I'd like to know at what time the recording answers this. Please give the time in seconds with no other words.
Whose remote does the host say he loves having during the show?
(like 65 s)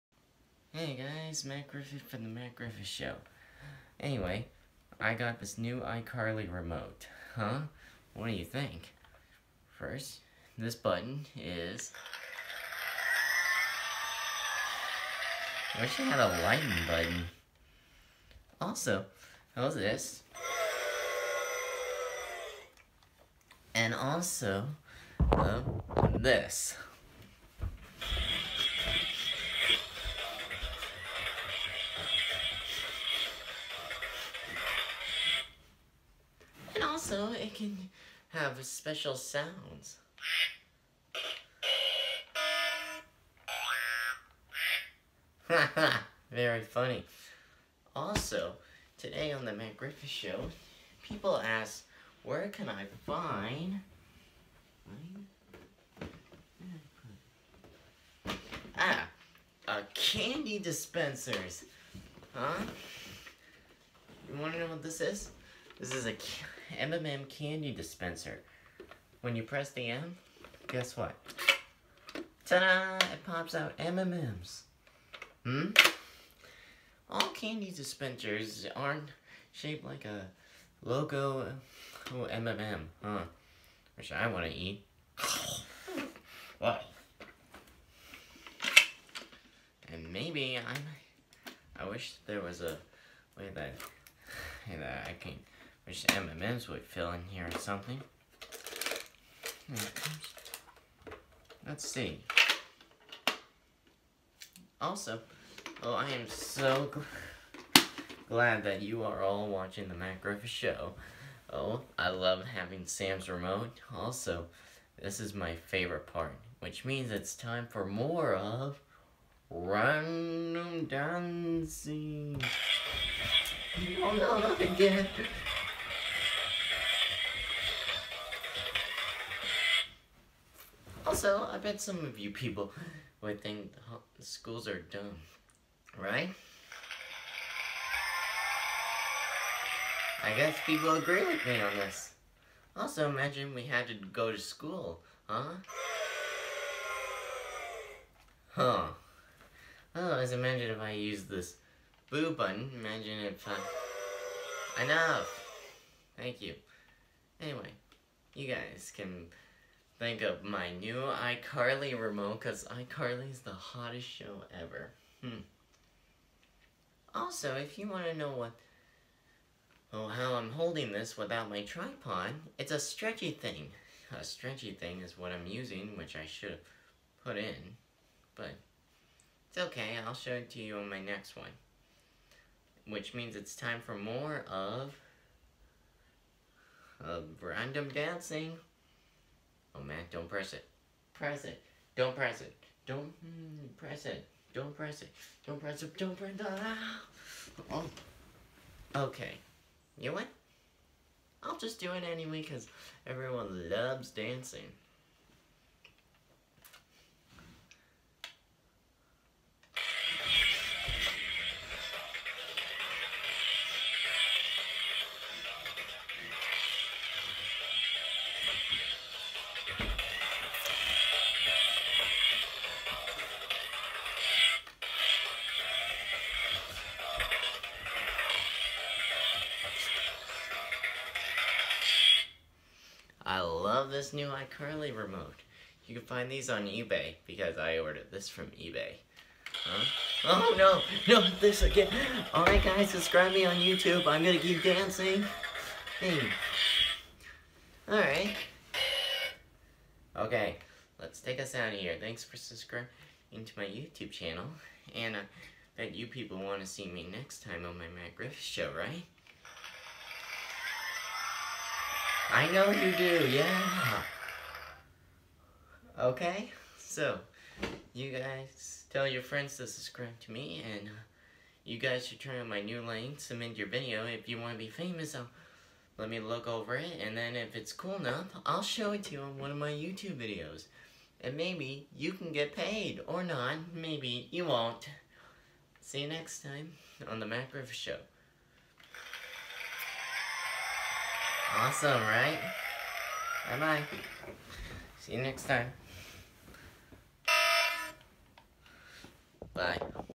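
112 s.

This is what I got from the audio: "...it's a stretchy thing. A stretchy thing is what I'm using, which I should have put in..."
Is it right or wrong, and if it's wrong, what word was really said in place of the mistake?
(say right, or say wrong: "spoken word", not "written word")
right.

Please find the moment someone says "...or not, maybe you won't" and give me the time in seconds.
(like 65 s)
283 s.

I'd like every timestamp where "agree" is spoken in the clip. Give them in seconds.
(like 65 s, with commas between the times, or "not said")
140 s.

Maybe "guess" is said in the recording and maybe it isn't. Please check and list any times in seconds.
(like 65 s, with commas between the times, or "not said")
70 s, 140 s.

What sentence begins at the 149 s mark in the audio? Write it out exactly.
Oh, as imagine if I use this boo button.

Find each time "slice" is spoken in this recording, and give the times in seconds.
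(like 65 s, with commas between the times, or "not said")
not said.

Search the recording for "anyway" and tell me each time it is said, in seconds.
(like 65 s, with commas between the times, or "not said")
3 s, 157 s, 202 s.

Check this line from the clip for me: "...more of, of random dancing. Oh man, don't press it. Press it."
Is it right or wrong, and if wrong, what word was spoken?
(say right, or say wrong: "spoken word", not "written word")
right.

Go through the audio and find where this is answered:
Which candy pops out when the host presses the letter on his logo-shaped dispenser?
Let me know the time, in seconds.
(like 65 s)
73 s.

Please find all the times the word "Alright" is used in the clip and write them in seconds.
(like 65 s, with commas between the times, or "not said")
242 s, 247 s.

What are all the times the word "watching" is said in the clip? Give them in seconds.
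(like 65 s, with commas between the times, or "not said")
109 s.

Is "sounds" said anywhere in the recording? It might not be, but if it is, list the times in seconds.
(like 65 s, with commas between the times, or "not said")
39 s.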